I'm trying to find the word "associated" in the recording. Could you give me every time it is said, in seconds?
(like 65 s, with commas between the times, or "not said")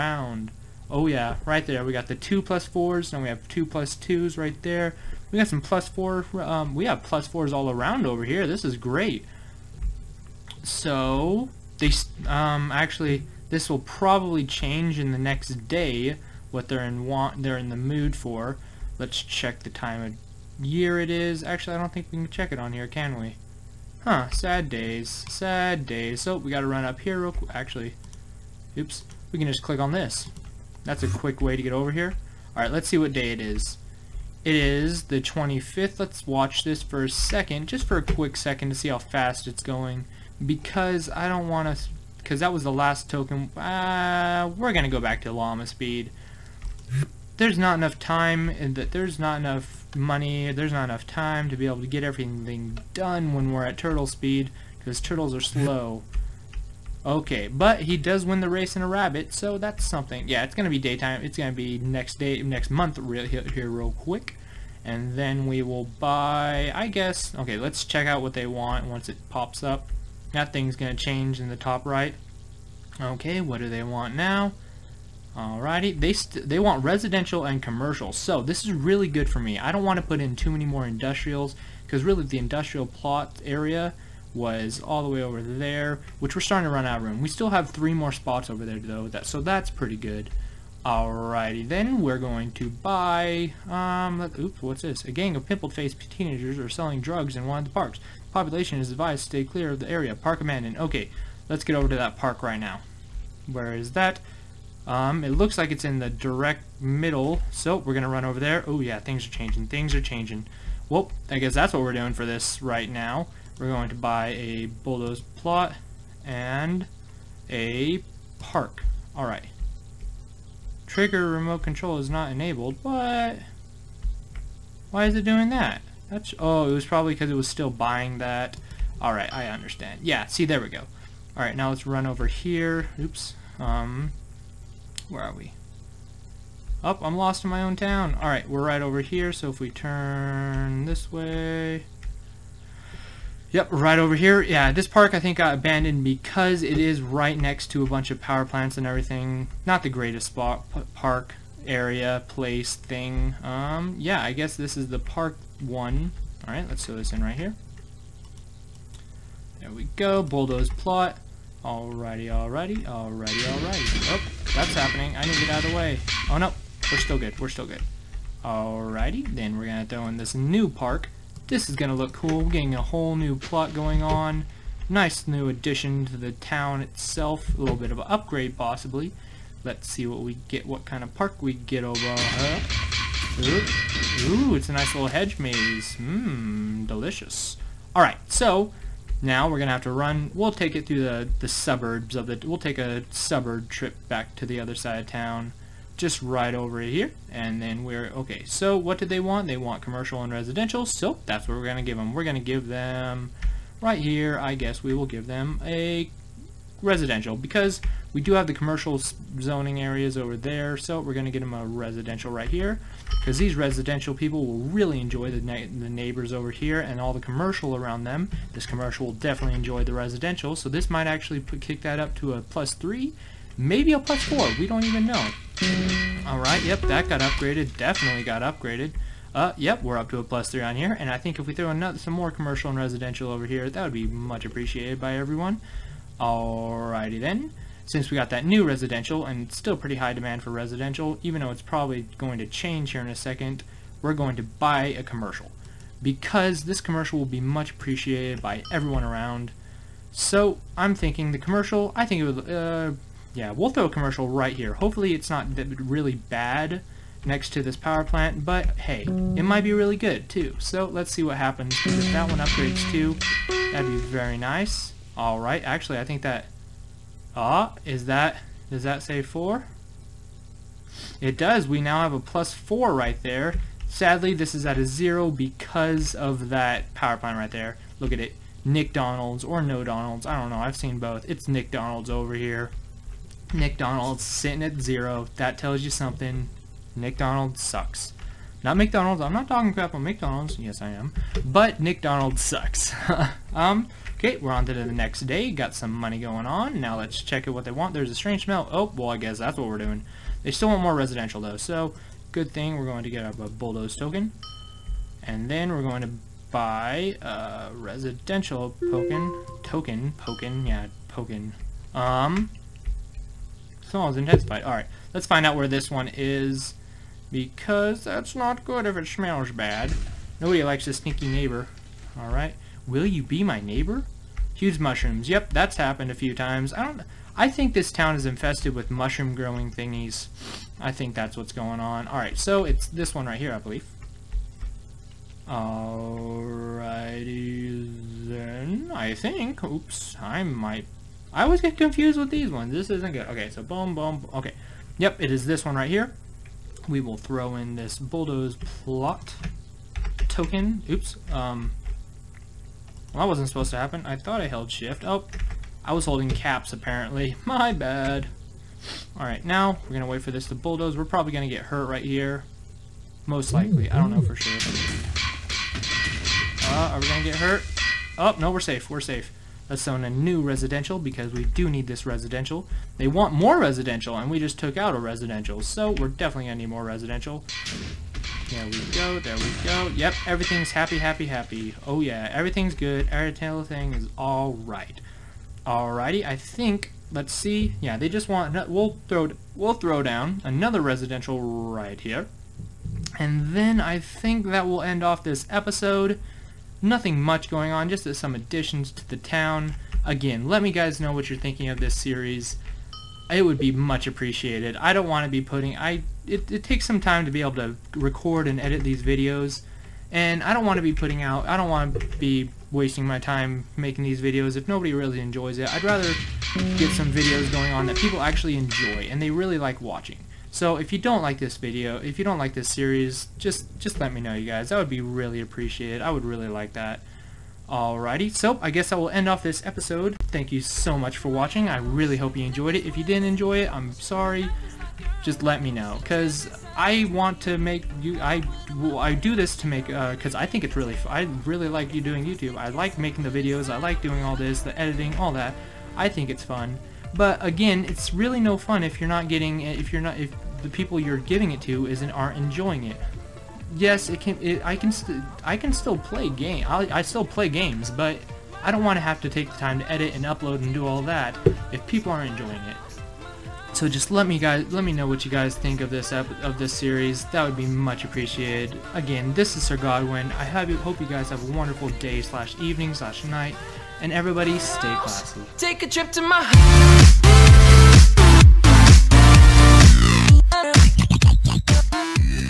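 not said.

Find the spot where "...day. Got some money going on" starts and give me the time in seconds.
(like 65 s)
295 s.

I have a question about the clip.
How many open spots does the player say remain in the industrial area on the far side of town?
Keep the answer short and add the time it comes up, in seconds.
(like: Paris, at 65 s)
3, at 87 s.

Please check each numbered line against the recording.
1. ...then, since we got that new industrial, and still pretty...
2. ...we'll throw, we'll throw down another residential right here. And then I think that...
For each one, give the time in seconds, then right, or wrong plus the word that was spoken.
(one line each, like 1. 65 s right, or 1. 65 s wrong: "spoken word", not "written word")
1. 237 s wrong: "residential", not "industrial"
2. 388 s right.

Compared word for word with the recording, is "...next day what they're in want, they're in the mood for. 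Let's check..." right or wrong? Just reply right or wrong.
right.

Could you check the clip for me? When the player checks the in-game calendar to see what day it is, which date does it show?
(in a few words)
25th.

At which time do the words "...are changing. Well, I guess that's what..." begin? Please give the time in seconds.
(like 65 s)
109 s.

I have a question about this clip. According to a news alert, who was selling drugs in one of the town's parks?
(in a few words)
Pimpled-faced teenagers.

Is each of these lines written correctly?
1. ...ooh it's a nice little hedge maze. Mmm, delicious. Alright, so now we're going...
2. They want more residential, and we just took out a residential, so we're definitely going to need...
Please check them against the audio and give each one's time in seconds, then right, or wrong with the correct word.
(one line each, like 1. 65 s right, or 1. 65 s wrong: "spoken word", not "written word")
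1. 184 s right
2. 372 s right.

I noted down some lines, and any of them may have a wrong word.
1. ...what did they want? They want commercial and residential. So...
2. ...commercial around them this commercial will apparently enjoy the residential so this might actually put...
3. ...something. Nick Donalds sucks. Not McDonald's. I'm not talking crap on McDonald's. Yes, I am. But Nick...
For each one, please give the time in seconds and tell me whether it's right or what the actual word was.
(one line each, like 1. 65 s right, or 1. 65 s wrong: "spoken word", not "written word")
1. 198 s right
2. 217 s wrong: "definitely", not "apparently"
3. 285 s right.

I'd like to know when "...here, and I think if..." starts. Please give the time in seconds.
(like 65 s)
230 s.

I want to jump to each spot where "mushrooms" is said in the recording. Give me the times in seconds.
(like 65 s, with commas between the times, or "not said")
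324 s, 328 s.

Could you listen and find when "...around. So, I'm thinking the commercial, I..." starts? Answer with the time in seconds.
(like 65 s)
249 s.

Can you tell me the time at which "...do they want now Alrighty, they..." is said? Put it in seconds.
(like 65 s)
73 s.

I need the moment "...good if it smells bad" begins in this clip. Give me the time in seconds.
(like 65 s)
318 s.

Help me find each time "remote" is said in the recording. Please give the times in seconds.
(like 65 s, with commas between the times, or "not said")
121 s.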